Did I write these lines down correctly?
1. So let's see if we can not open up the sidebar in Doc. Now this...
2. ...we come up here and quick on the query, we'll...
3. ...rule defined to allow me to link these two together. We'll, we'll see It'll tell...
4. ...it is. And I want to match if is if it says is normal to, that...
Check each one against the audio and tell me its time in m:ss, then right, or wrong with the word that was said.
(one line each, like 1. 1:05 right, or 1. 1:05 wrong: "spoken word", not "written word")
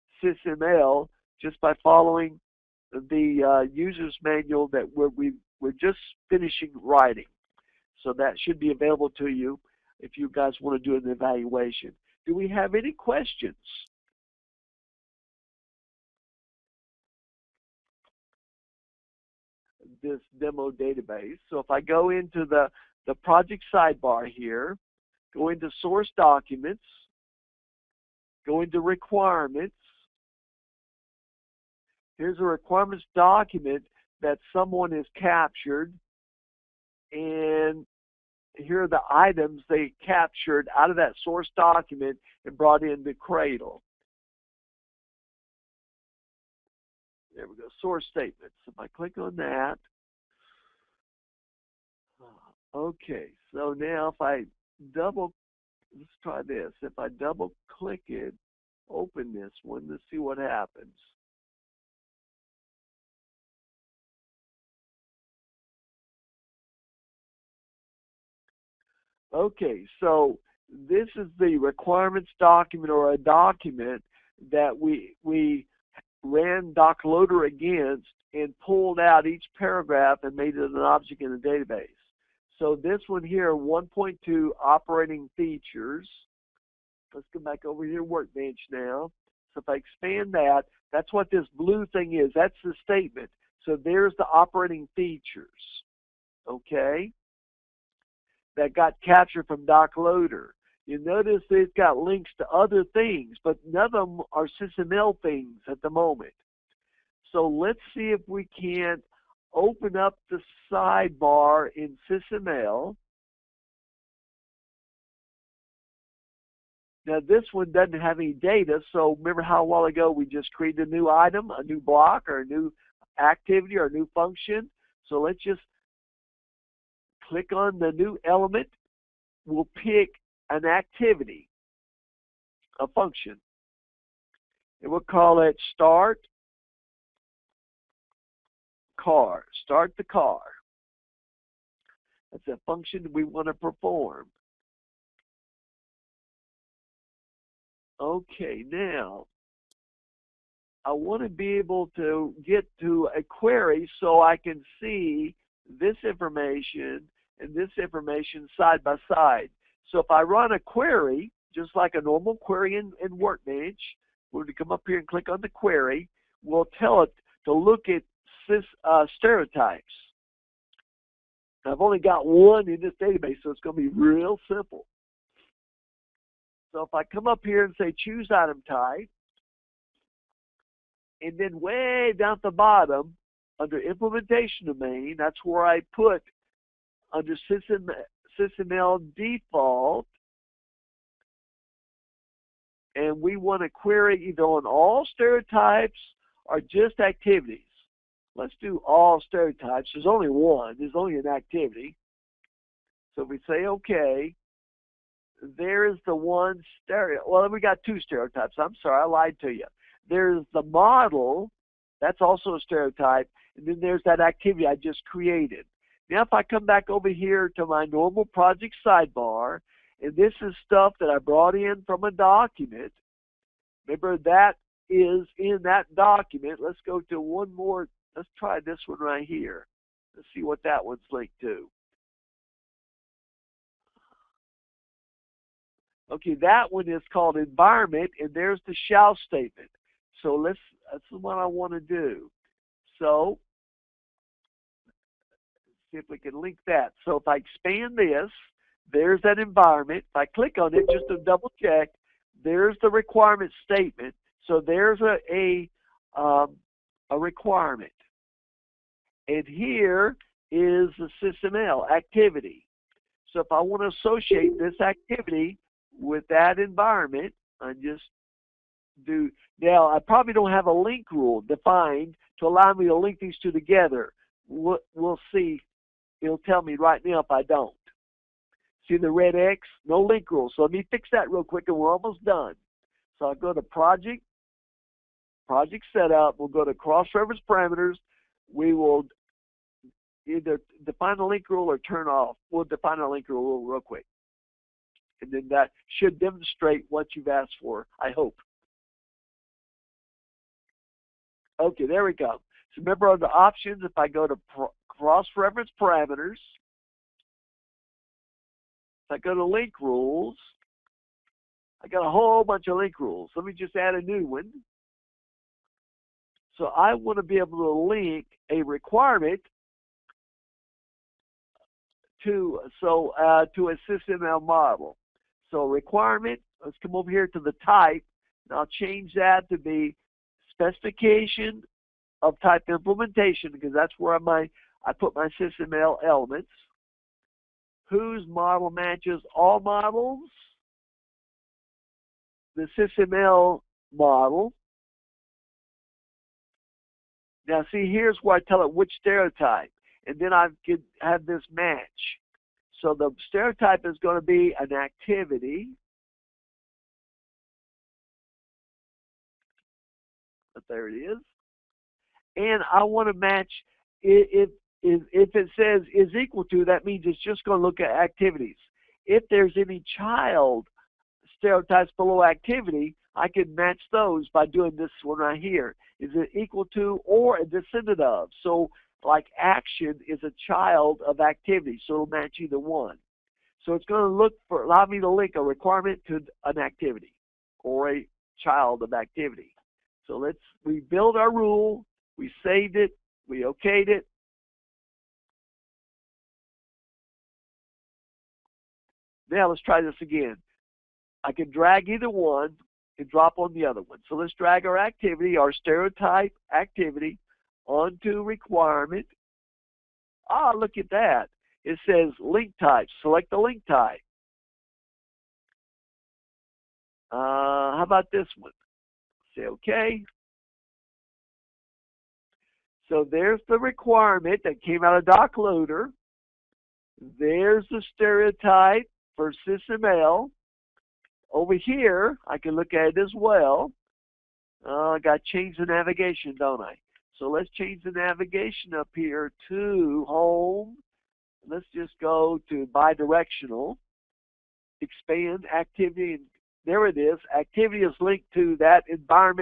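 1. 1:47 wrong: "SysML", not "Doc"
2. 2:44 wrong: "click", not "quick"
3. 4:31 right
4. 6:00 wrong: "equal", not "normal".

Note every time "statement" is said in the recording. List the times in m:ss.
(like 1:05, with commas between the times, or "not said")
0:48, 1:32, 3:59, 4:13.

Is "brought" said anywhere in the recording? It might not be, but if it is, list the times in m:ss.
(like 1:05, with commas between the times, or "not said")
0:42, 3:41.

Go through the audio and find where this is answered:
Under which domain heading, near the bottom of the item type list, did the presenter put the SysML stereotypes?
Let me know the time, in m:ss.
3:03.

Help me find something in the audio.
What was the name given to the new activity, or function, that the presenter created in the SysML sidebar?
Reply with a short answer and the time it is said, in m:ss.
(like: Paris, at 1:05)
Start the car, at 2:19.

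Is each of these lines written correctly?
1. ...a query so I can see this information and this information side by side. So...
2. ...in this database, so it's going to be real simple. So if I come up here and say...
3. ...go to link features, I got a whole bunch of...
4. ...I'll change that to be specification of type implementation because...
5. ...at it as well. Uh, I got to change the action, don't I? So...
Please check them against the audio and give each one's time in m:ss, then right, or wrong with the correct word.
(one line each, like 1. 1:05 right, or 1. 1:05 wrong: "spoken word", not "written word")
1. 2:33 right
2. 2:52 right
3. 5:09 wrong: "rules", not "features"
4. 5:28 right
5. 7:12 wrong: "navigation", not "action".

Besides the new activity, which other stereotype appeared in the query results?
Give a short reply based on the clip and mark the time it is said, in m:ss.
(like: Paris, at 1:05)
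The model, at 3:30.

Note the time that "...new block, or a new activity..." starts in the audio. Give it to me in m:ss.
2:01.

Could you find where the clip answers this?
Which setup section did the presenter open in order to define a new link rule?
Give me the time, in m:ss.
4:46.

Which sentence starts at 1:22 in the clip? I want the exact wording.
So this one here, 1.2 operating features.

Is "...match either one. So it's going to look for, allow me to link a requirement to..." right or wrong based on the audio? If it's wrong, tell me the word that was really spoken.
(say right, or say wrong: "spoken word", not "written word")
right.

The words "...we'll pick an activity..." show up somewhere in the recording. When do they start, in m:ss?
2:09.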